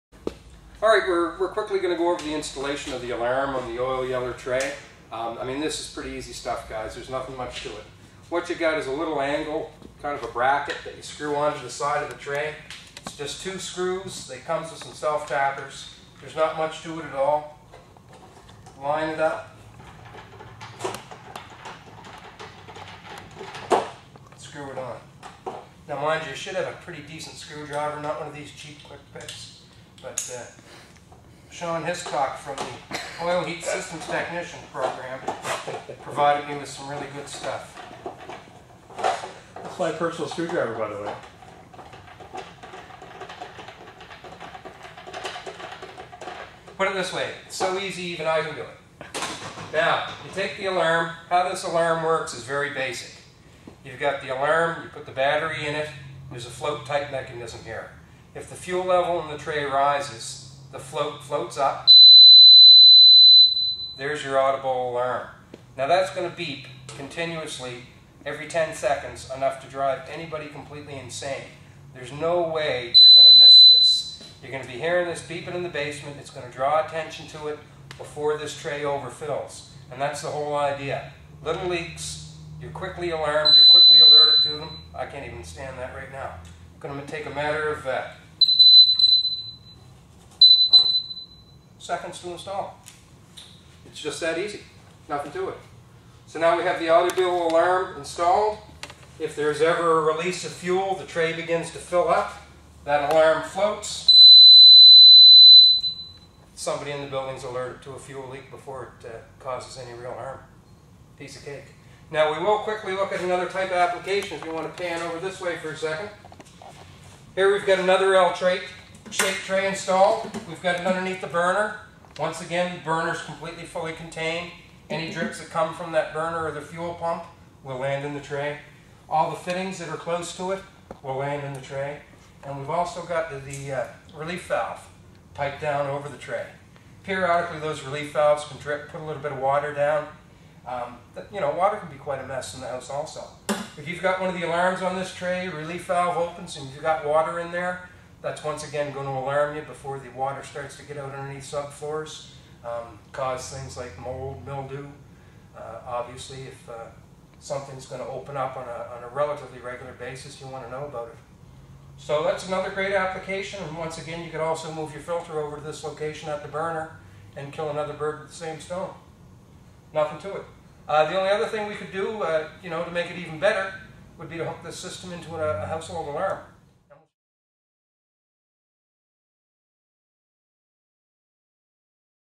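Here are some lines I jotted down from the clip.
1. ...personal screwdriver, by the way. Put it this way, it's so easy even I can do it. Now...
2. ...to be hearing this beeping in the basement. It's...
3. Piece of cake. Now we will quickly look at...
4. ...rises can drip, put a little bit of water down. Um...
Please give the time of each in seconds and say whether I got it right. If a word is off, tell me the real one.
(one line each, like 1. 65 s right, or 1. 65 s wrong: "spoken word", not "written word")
1. 39 s right
2. 74 s right
3. 111 s right
4. 138 s wrong: "valves", not "rises".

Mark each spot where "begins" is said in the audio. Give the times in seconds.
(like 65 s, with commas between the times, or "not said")
101 s.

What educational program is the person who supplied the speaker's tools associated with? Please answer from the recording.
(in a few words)
Oil Heat Systems Technician Program.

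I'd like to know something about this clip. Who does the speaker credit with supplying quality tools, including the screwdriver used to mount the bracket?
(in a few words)
Sean Hiscock.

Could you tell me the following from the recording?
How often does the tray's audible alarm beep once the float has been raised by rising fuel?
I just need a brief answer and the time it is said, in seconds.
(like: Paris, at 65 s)
every 10 seconds, at 68 s.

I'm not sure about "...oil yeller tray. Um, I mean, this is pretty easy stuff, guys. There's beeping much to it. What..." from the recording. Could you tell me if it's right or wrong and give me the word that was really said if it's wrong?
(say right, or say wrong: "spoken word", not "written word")
wrong: "nothing", not "beeping".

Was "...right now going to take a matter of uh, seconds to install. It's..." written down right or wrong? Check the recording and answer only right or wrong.
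right.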